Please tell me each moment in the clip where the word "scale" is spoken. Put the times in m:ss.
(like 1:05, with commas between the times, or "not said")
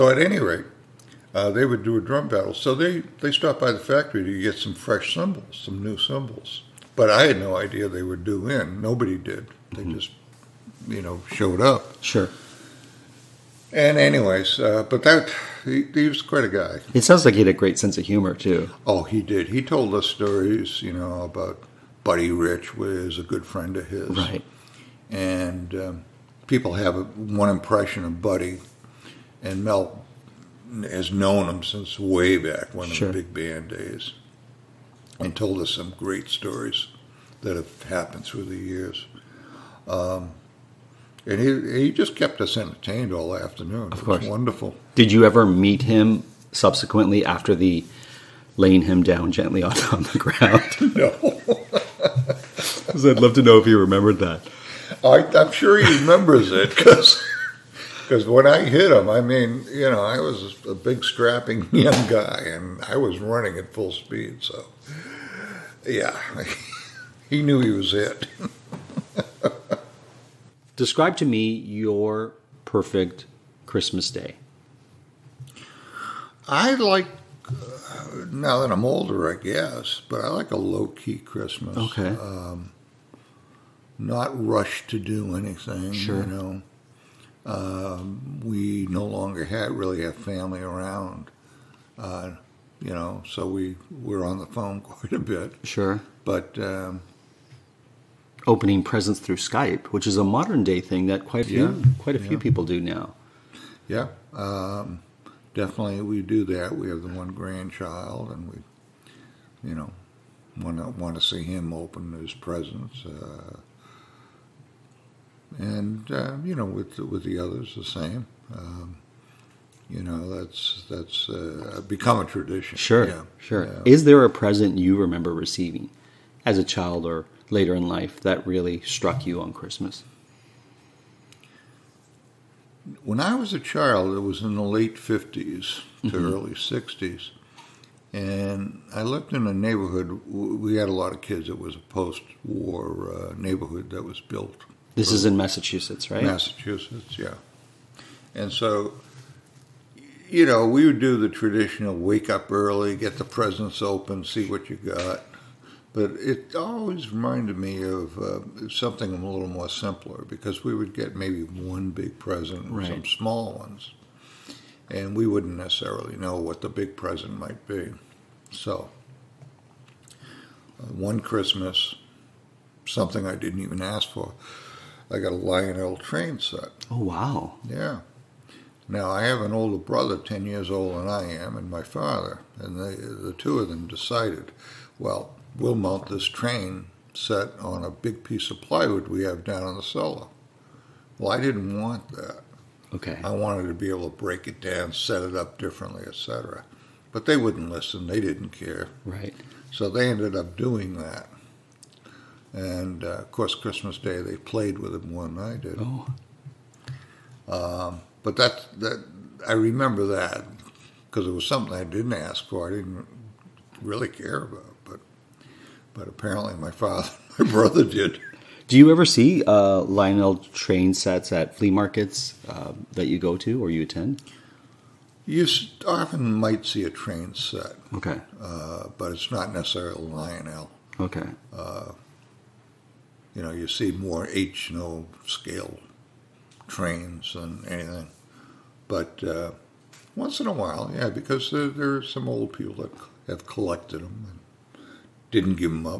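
3:55.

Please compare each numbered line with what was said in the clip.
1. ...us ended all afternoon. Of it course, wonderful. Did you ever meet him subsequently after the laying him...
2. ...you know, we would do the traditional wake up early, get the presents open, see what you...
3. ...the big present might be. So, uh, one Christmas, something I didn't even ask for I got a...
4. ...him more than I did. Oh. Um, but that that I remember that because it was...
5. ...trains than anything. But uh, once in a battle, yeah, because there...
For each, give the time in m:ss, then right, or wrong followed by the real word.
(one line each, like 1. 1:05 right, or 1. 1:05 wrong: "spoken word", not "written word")
1. 0:42 wrong: "entertained", not "ended"
2. 2:30 right
3. 2:46 right
4. 3:24 right
5. 3:56 wrong: "while", not "battle".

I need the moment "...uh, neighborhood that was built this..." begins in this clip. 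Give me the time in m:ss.
2:23.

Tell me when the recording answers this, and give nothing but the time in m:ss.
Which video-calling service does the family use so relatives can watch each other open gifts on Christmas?
1:39.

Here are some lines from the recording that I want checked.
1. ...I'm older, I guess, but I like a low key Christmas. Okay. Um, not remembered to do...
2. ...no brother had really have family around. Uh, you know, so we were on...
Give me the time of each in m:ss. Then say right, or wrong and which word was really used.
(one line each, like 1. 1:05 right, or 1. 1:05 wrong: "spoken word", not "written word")
1. 1:18 wrong: "rushed", not "remembered"
2. 1:28 wrong: "longer", not "brother".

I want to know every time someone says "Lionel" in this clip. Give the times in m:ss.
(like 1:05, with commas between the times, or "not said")
2:55, 3:39, 3:50.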